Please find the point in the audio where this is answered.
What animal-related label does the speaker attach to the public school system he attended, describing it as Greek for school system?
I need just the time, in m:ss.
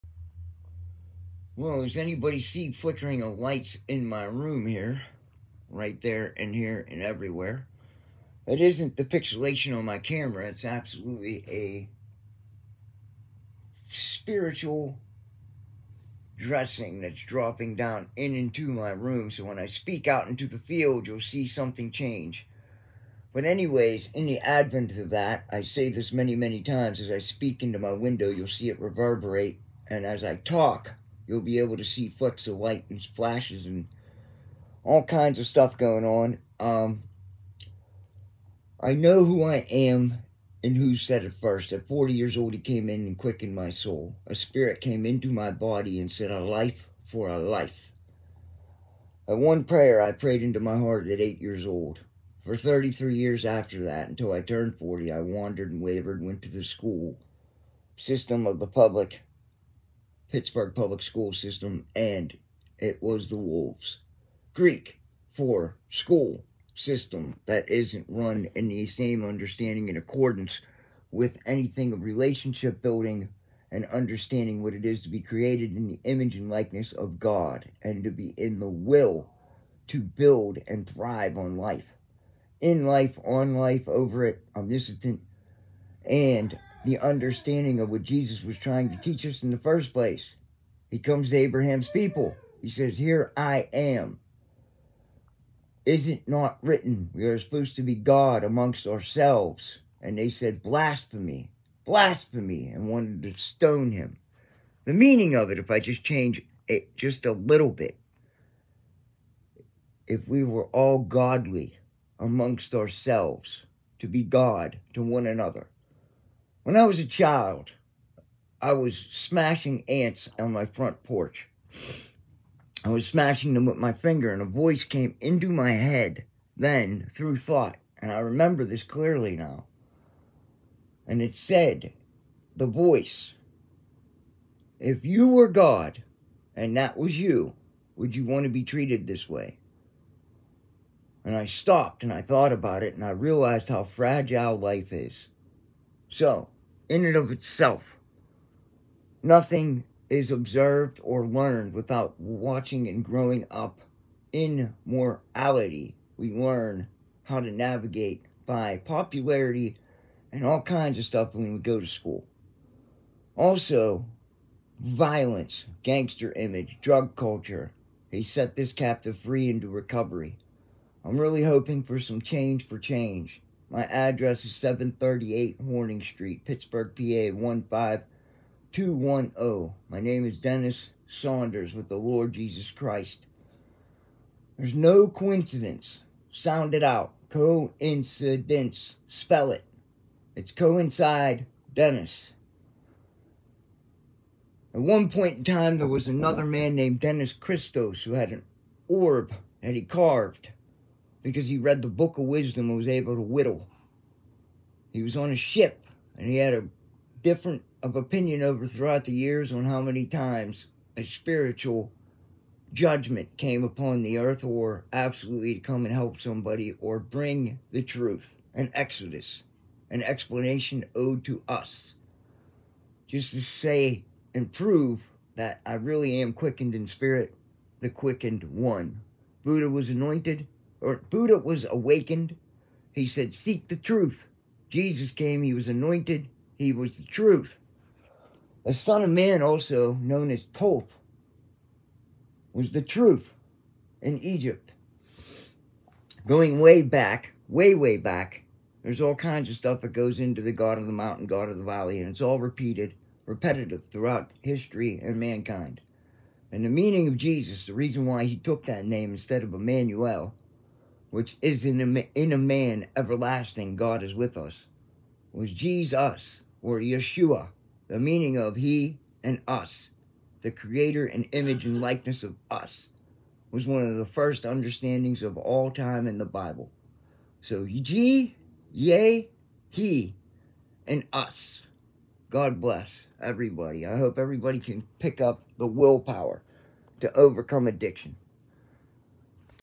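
1:03.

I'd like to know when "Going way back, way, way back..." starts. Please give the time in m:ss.
4:06.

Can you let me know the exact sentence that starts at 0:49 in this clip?
At one prayer I prayed into my heart at 8 years old.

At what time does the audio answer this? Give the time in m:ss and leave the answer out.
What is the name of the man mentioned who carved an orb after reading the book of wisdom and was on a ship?
3:16.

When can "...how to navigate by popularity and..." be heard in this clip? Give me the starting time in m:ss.
2:37.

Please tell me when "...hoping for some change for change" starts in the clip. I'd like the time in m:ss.
2:51.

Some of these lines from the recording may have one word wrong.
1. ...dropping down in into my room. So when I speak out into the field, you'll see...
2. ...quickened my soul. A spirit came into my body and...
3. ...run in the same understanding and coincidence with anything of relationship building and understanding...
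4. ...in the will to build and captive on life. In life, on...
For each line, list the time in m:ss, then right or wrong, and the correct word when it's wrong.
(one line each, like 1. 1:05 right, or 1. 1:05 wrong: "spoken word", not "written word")
1. 0:17 right
2. 0:43 right
3. 1:08 wrong: "accordance", not "coincidence"
4. 1:18 wrong: "thrive", not "captive".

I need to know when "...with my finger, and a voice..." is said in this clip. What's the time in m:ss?
2:03.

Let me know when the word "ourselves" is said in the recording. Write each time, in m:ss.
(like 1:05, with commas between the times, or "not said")
1:38, 1:52.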